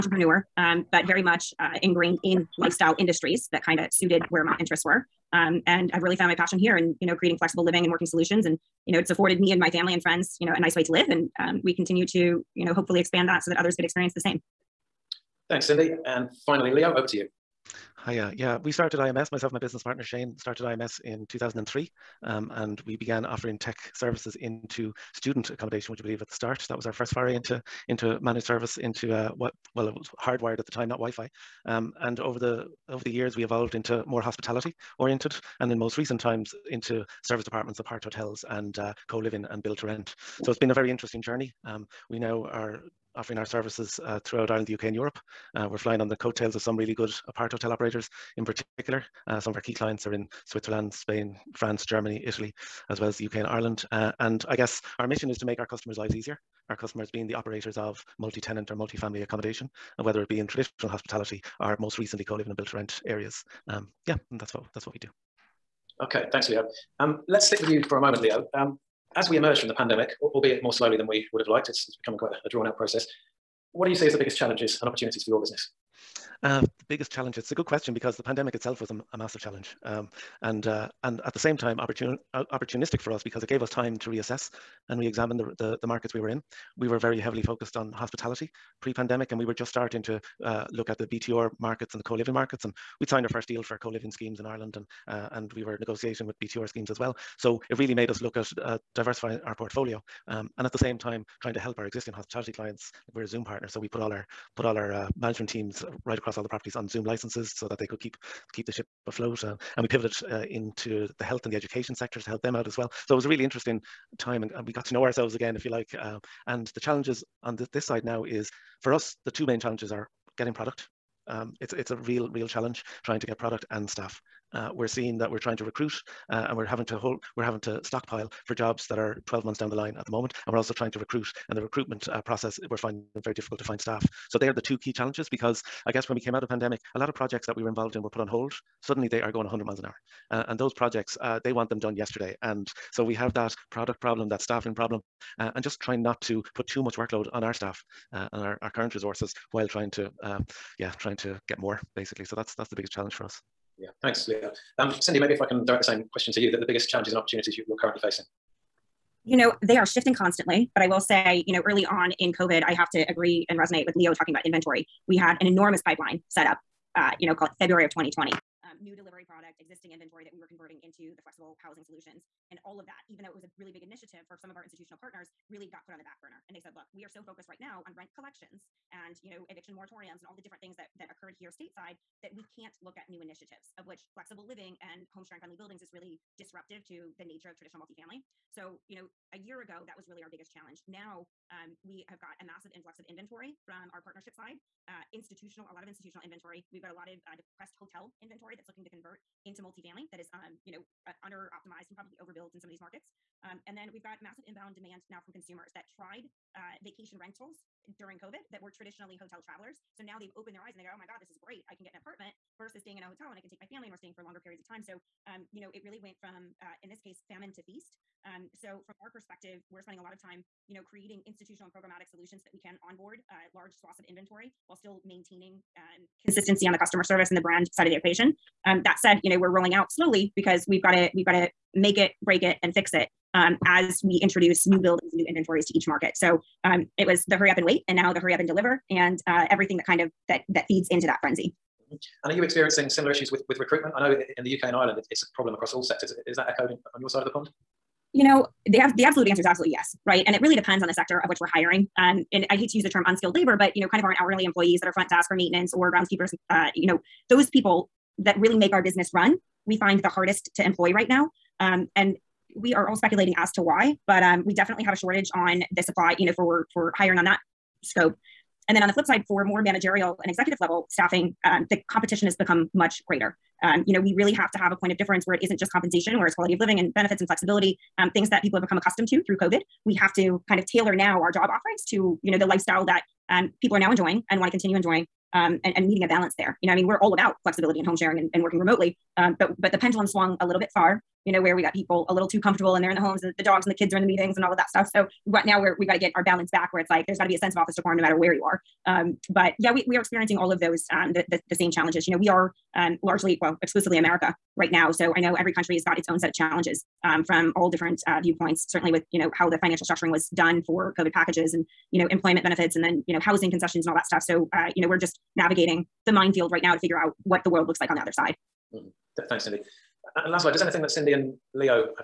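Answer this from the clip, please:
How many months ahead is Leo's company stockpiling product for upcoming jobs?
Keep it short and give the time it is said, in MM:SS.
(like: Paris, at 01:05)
12, at 02:09.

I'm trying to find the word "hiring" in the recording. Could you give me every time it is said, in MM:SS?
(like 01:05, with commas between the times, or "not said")
04:11, 04:26.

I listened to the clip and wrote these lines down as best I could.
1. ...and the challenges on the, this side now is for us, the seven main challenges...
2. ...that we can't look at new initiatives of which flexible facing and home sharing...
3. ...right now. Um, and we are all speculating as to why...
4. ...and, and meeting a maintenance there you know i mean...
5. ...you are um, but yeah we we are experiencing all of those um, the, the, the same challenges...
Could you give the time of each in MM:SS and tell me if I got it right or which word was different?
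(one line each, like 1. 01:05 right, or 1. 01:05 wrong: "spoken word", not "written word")
1. 01:56 wrong: "two", not "seven"
2. 03:02 wrong: "living", not "facing"
3. 04:20 right
4. 04:45 wrong: "balance", not "maintenance"
5. 04:58 right.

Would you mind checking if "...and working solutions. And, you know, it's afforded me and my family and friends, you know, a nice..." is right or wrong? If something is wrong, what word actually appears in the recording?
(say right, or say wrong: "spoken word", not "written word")
right.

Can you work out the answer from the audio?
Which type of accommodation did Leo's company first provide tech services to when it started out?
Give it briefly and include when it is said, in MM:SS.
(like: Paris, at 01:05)
Student accommodation, at 00:25.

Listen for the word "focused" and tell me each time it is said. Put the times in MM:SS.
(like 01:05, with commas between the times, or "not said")
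01:27, 02:57.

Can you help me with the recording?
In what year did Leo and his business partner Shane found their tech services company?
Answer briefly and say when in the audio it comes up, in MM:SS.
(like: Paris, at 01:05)
2003, at 00:21.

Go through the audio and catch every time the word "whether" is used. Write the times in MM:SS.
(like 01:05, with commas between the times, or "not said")
00:59.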